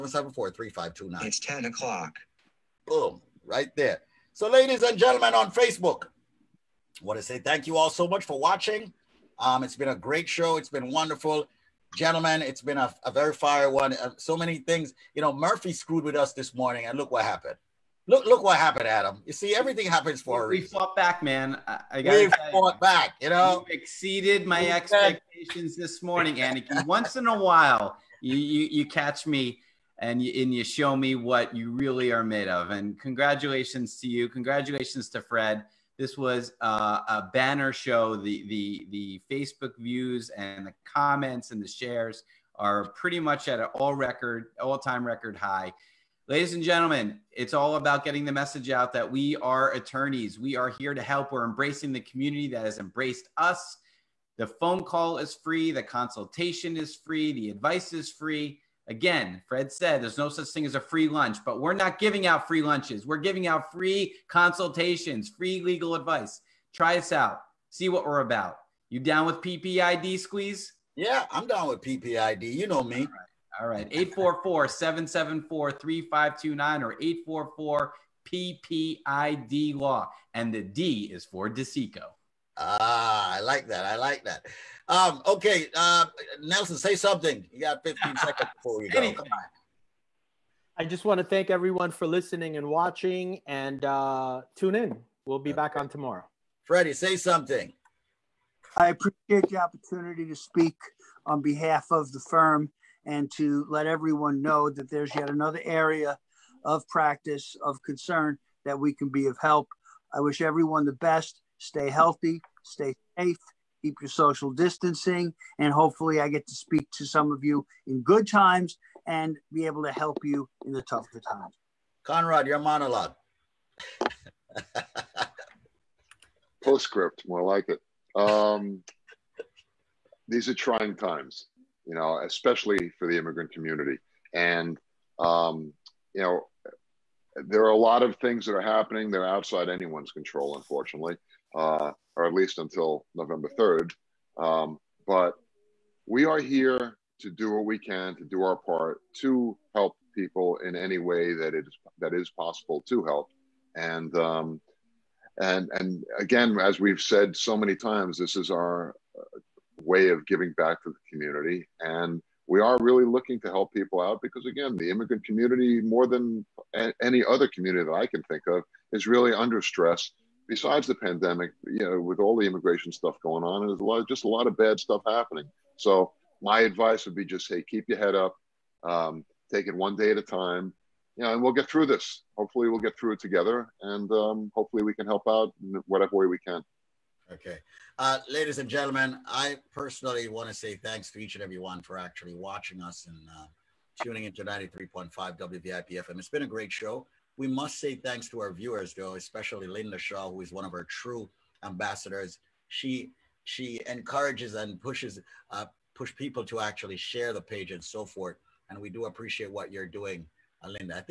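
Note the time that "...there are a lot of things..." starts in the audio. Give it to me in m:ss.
2:17.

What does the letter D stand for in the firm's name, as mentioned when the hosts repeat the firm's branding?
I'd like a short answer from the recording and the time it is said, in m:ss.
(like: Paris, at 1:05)
DeCicco, at 1:21.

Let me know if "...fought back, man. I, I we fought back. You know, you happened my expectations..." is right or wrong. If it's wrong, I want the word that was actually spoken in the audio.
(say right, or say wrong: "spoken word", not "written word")
wrong: "exceeded", not "happened".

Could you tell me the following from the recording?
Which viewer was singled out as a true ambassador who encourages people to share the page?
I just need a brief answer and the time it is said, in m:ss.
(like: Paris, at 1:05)
Linda Shaw, at 3:19.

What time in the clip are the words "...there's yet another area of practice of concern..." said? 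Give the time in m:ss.
1:44.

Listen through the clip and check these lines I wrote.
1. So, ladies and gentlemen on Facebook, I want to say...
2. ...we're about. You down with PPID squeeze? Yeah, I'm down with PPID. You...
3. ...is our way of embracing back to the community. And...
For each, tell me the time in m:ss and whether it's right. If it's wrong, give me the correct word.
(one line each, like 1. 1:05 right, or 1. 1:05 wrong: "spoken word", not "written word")
1. 0:04 right
2. 1:08 right
3. 2:38 wrong: "giving", not "embracing".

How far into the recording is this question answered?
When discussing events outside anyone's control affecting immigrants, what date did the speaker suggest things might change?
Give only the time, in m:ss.
2:23.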